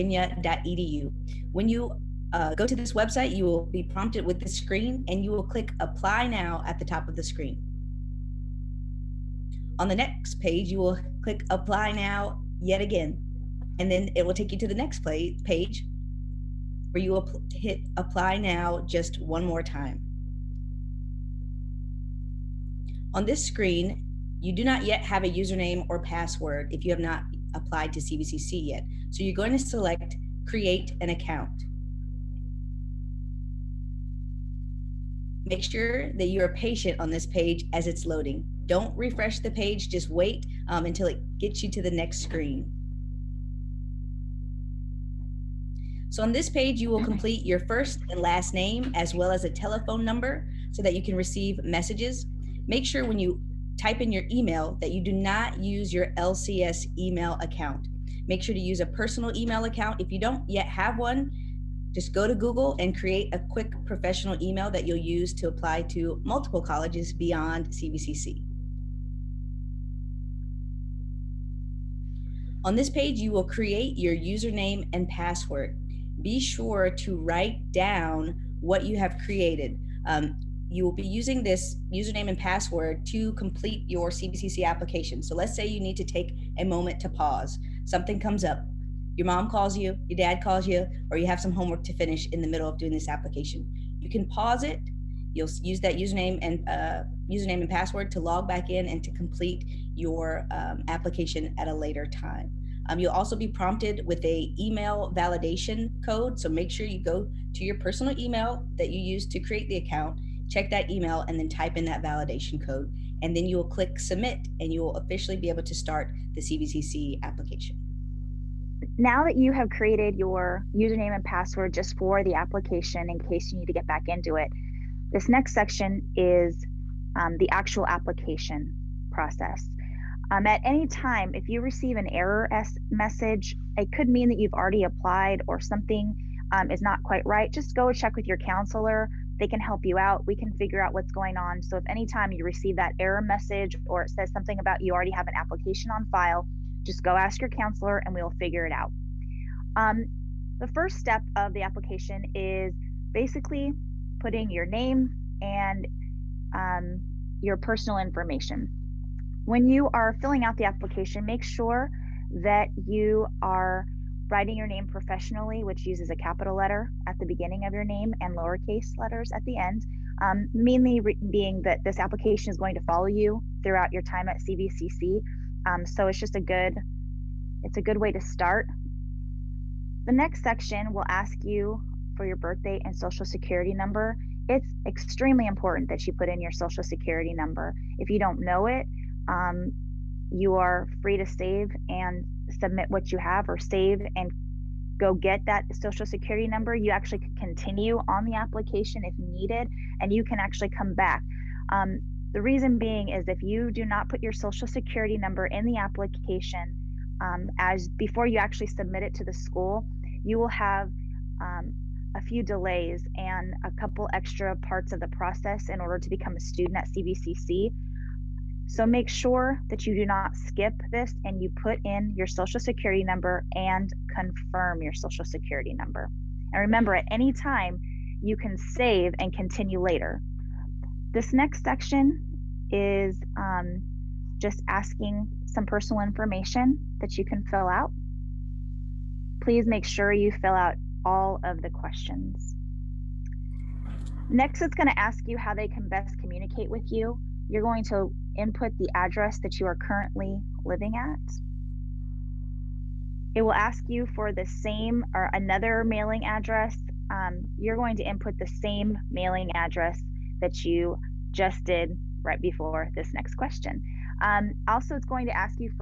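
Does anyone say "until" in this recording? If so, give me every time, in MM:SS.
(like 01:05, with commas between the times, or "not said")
00:40.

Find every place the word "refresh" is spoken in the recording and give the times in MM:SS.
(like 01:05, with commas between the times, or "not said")
00:38.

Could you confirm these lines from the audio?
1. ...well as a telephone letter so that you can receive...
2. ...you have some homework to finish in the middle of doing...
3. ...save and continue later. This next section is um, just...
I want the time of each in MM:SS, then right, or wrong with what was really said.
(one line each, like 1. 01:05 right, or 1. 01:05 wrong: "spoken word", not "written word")
1. 00:49 wrong: "number", not "letter"
2. 01:31 right
3. 03:48 right.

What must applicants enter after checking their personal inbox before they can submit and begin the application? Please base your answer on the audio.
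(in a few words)
email validation code.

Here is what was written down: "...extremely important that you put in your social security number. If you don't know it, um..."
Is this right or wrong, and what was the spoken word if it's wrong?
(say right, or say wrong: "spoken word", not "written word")
right.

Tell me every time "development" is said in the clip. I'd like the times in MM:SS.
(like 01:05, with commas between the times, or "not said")
not said.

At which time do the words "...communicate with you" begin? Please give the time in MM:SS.
04:06.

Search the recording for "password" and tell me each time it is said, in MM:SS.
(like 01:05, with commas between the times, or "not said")
00:25, 01:15, 01:22, 01:37, 02:01.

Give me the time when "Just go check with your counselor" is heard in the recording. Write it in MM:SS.
02:17.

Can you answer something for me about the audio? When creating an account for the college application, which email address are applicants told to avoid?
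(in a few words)
LCS email account.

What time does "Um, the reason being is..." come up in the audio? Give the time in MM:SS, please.
03:21.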